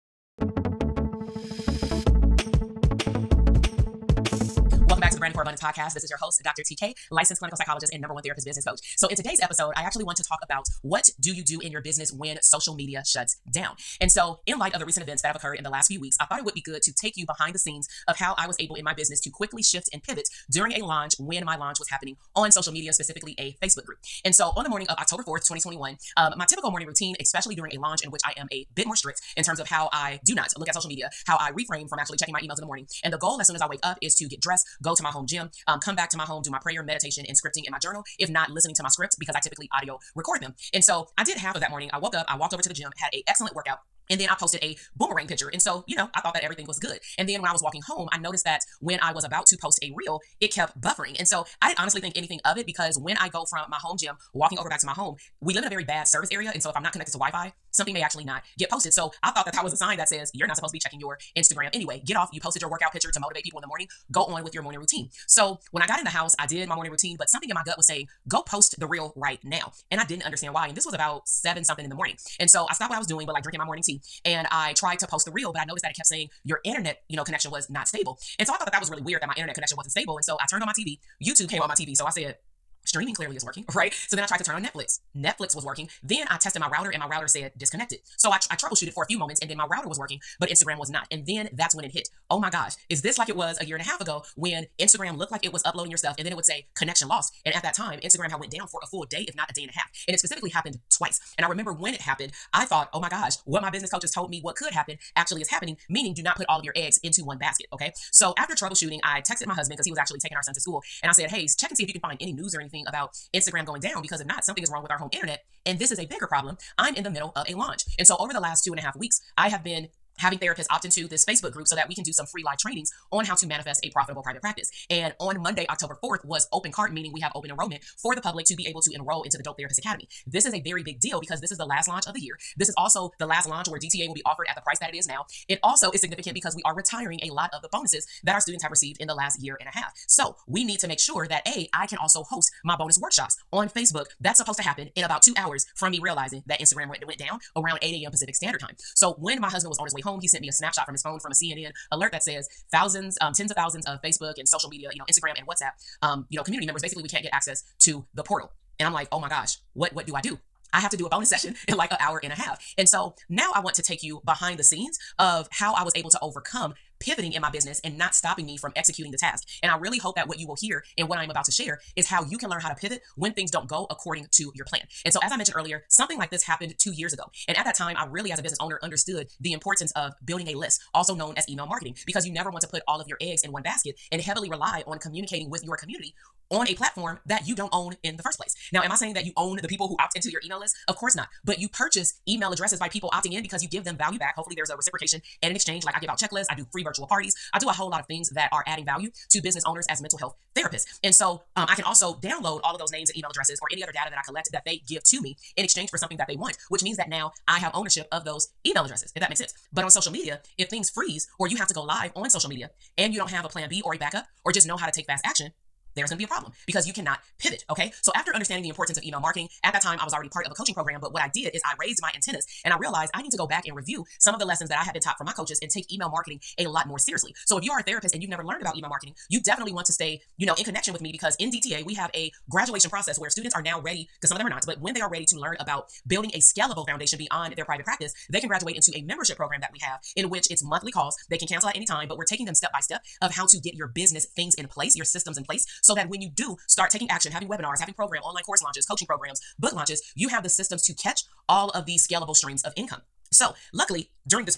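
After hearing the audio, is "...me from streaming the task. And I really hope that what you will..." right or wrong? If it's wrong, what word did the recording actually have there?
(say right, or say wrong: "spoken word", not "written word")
wrong: "executing", not "streaming".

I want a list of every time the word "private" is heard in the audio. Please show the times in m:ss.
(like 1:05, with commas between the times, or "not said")
2:04, 3:57.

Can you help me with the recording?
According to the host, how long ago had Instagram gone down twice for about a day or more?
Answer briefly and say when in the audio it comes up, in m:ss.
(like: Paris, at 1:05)
a year and a half ago, at 1:33.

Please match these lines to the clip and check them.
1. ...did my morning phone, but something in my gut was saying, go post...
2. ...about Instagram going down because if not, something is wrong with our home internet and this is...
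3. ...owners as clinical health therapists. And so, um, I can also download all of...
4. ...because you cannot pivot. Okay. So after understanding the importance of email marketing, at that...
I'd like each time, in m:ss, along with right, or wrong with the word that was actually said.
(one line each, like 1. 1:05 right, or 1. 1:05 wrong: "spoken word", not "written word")
1. 1:06 wrong: "routine", not "phone"
2. 1:52 right
3. 3:19 wrong: "mental", not "clinical"
4. 3:36 right.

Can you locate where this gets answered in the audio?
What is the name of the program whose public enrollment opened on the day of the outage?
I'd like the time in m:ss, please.
2:09.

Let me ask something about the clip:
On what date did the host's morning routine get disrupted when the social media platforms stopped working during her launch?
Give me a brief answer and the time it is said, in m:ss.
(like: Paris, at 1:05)
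October 4th, 2021, at 0:24.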